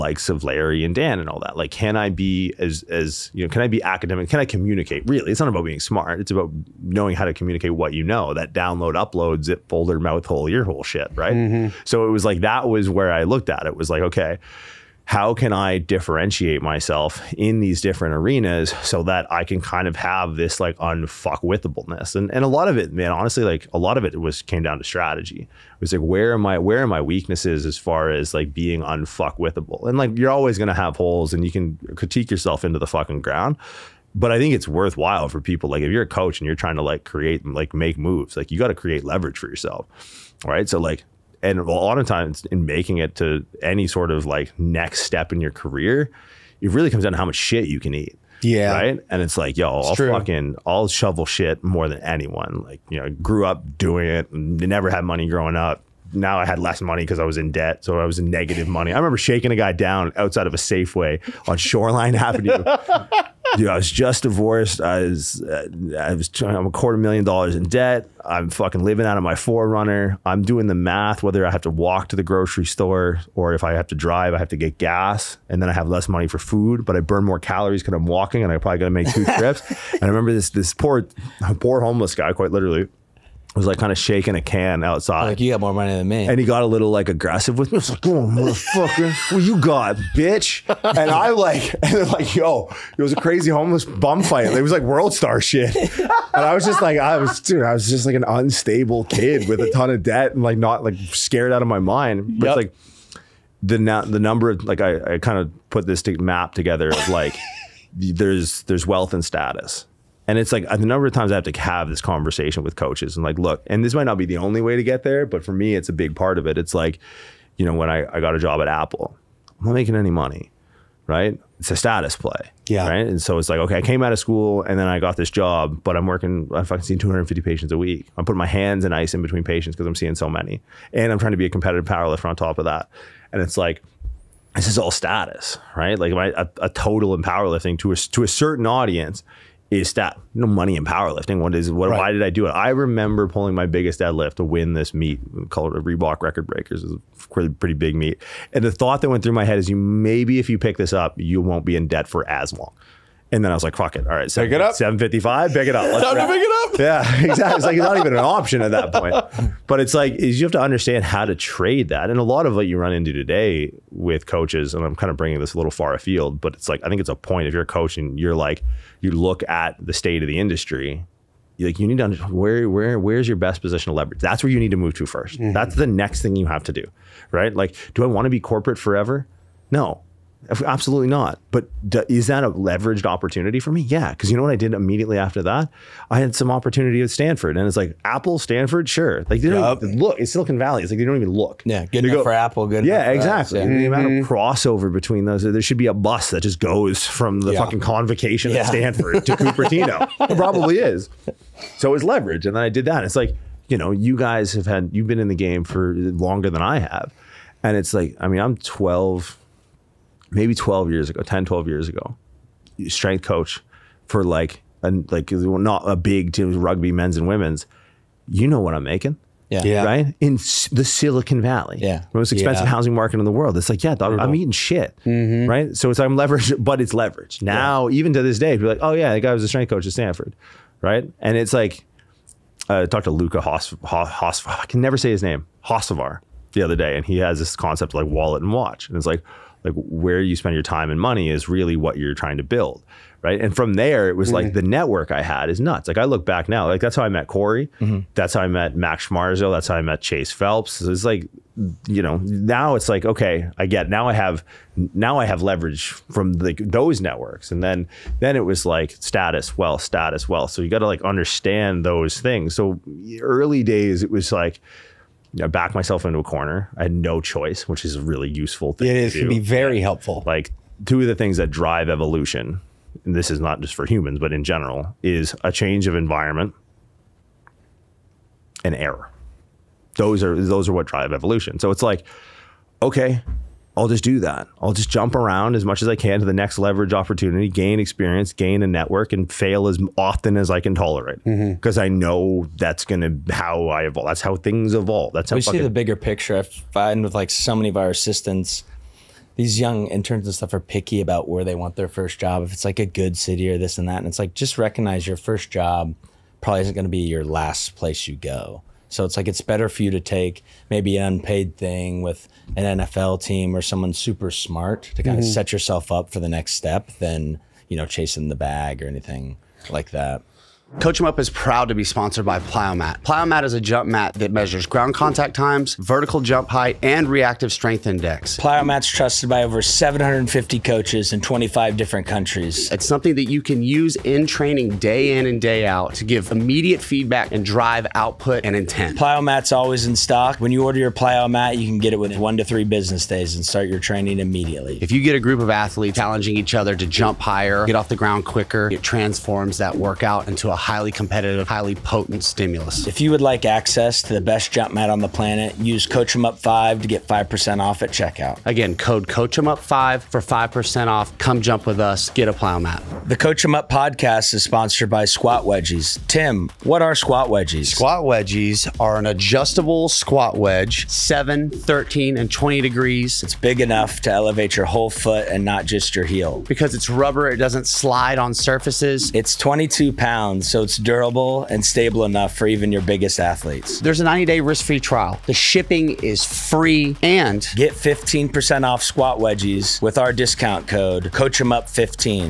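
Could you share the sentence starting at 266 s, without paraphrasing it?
I had no choice, which is a really useful thing.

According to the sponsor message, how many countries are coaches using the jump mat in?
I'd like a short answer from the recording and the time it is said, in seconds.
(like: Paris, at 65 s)
25, at 331 s.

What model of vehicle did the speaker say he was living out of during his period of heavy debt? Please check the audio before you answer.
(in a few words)
4Runner.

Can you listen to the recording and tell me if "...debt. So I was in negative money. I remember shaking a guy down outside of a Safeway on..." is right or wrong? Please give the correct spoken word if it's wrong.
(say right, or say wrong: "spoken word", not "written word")
right.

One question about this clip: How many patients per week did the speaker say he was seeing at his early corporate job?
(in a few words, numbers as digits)
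250.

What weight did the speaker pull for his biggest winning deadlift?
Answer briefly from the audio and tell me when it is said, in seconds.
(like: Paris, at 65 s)
755, at 154 s.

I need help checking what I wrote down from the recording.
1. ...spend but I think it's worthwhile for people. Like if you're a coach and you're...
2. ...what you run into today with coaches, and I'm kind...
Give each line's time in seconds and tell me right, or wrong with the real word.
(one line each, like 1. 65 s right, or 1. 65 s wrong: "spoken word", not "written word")
1. 33 s wrong: "ground", not "spend"
2. 162 s right.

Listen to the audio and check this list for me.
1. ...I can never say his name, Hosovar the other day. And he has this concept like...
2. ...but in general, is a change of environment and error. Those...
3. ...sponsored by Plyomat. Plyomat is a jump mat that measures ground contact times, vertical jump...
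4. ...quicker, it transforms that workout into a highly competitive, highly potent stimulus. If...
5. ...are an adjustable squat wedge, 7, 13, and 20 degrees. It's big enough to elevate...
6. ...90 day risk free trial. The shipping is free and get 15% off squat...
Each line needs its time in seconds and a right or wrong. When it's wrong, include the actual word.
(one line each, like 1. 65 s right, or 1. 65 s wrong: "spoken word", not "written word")
1. 234 s right
2. 274 s right
3. 321 s right
4. 348 s right
5. 368 s right
6. 384 s right.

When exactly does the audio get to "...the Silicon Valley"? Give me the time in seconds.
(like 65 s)
220 s.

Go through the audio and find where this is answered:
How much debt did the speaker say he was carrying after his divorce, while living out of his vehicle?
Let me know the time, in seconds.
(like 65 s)
66 s.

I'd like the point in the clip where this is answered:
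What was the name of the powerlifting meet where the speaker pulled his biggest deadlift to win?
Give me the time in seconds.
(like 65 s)
145 s.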